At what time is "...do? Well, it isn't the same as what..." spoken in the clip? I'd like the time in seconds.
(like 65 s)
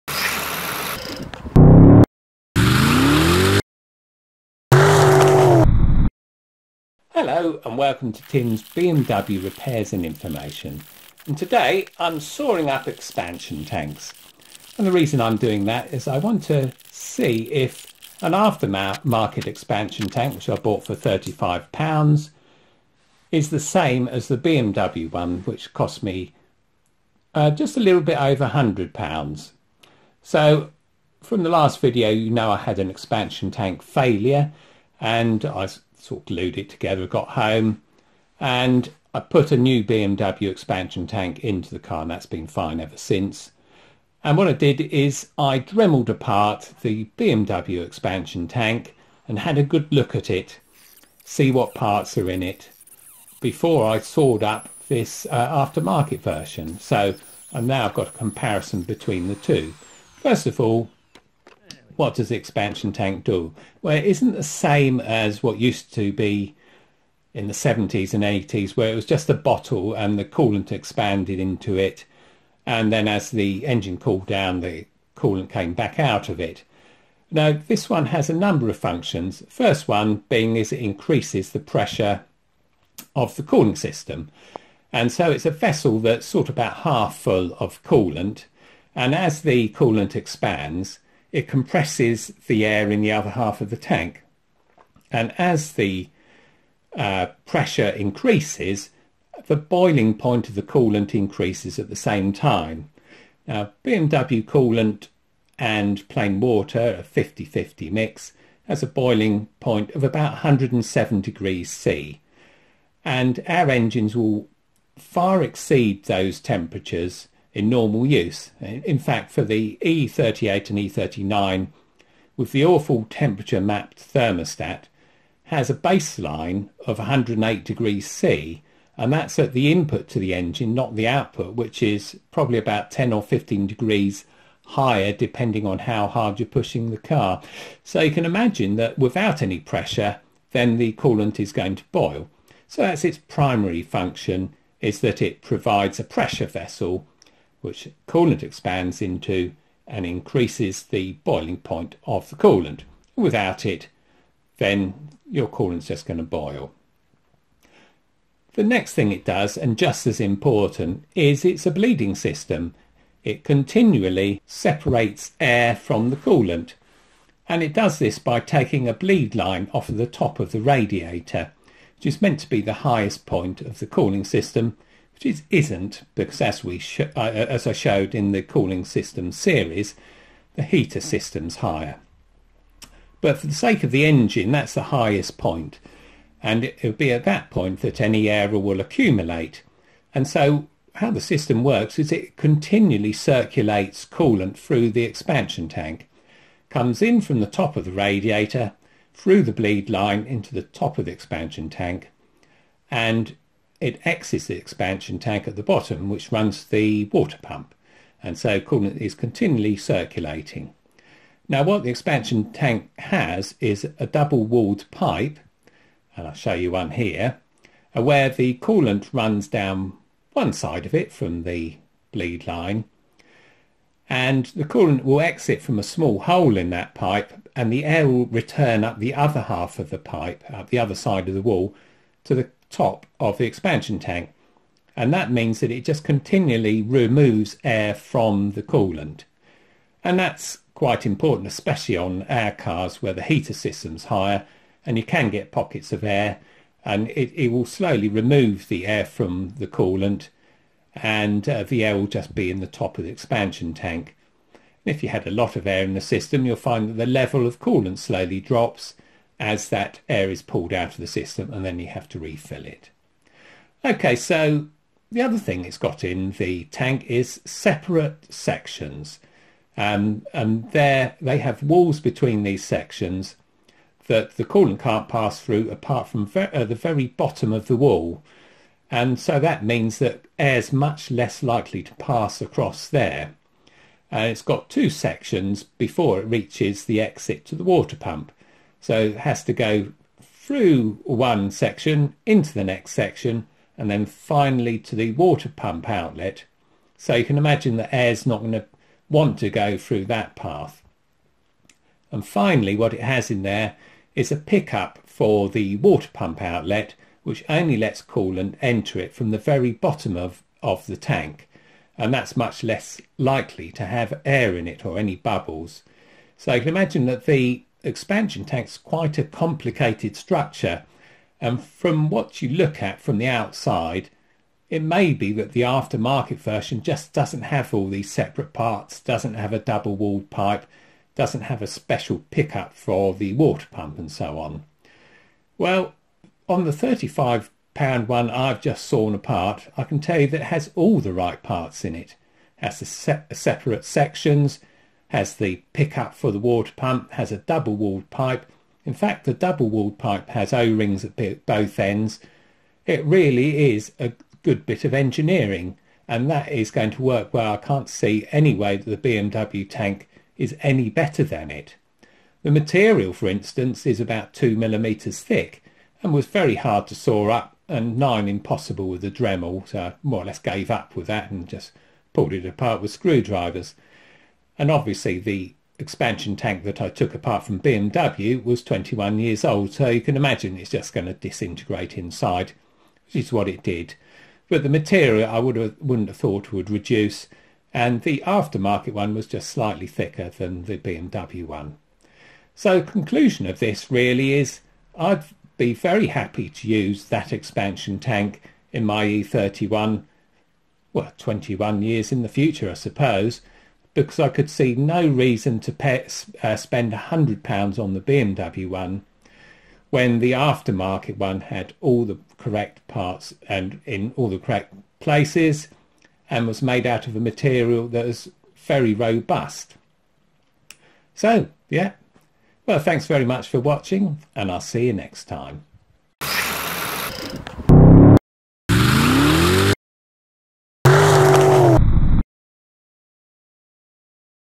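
63 s.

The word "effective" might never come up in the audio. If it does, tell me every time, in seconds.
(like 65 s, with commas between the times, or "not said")
not said.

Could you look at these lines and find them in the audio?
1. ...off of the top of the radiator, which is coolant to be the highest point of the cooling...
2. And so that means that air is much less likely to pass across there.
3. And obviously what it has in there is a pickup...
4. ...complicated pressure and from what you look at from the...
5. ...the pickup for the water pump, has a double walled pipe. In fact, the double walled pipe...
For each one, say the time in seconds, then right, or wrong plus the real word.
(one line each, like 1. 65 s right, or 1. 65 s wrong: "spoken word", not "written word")
1. 169 s wrong: "meant", not "coolant"
2. 278 s right
3. 302 s wrong: "finally", not "obviously"
4. 319 s wrong: "structure", not "pressure"
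5. 345 s right.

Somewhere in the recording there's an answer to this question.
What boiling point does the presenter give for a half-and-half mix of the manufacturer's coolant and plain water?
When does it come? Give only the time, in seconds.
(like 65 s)
110 s.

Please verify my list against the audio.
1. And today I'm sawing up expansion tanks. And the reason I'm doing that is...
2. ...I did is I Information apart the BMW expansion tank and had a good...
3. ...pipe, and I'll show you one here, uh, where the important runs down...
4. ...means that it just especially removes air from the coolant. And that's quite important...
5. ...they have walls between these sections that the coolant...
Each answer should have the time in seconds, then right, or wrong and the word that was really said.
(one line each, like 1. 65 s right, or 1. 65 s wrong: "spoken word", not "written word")
1. 11 s right
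2. 44 s wrong: "Dremelled", not "Information"
3. 214 s wrong: "coolant", not "important"
4. 235 s wrong: "continually", not "especially"
5. 271 s right.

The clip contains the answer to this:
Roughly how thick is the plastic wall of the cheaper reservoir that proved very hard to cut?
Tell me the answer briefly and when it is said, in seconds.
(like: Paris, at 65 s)
2 millimetres, at 364 s.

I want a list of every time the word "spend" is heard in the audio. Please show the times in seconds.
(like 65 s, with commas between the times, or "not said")
406 s.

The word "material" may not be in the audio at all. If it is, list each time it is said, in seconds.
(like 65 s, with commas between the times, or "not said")
362 s, 384 s, 417 s.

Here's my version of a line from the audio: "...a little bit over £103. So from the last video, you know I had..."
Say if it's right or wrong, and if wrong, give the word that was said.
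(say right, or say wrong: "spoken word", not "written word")
wrong: "100", not "103".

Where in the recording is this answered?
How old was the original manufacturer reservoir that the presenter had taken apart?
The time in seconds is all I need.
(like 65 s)
378 s.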